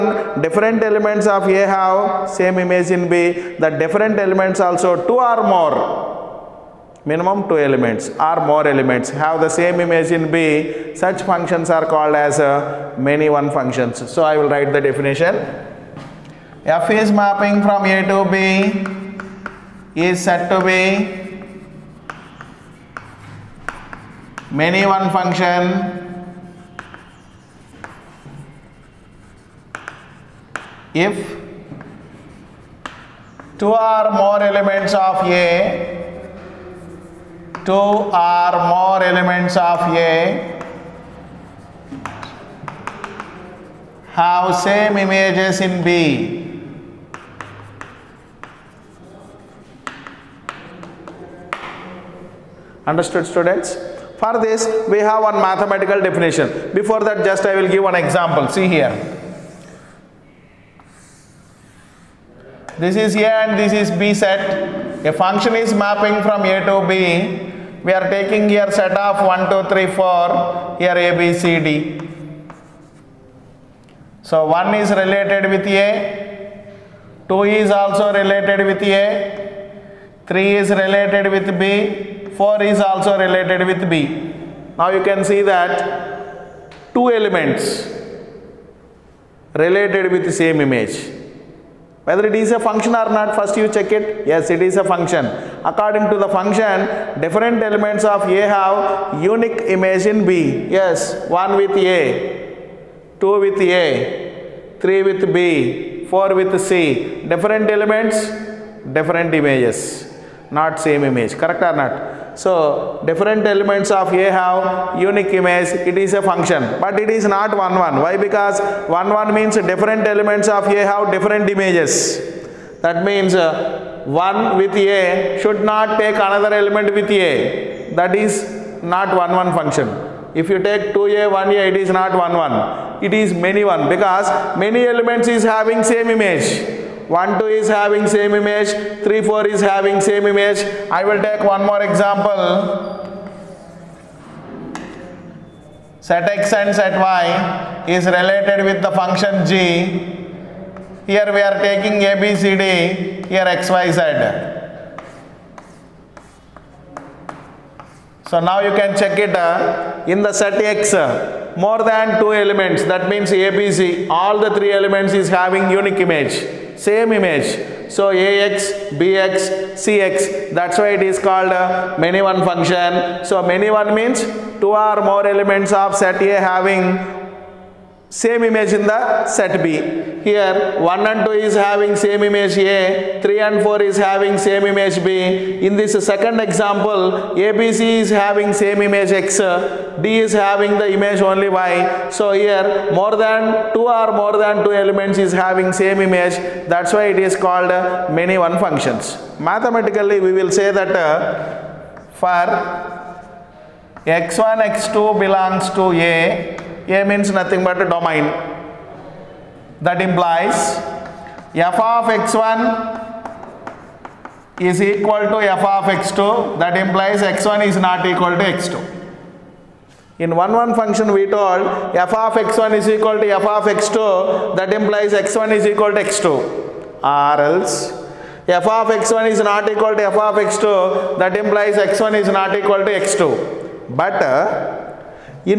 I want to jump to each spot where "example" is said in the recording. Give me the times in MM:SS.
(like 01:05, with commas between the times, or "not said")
00:57, 02:21, 03:06.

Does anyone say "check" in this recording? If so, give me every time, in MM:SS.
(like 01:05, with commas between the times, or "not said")
01:33, 02:38.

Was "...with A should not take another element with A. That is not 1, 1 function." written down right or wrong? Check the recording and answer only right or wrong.
right.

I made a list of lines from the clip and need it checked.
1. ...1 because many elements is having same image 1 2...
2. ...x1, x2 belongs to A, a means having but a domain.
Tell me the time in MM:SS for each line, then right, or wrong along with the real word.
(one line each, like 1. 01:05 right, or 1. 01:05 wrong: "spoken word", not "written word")
1. 02:13 right
2. 03:24 wrong: "nothing", not "having".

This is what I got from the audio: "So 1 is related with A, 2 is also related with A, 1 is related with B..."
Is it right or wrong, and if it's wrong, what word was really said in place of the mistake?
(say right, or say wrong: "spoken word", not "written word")
wrong: "3", not "1".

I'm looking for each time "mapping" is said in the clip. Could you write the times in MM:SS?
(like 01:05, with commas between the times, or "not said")
00:17, 01:05.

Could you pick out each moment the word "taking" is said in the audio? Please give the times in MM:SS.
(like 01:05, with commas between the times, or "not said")
01:08, 02:31.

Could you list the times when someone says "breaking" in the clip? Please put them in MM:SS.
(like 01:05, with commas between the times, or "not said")
not said.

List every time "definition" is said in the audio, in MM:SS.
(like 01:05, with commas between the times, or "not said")
00:14, 00:56.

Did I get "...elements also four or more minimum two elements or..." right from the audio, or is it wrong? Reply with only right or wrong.
wrong.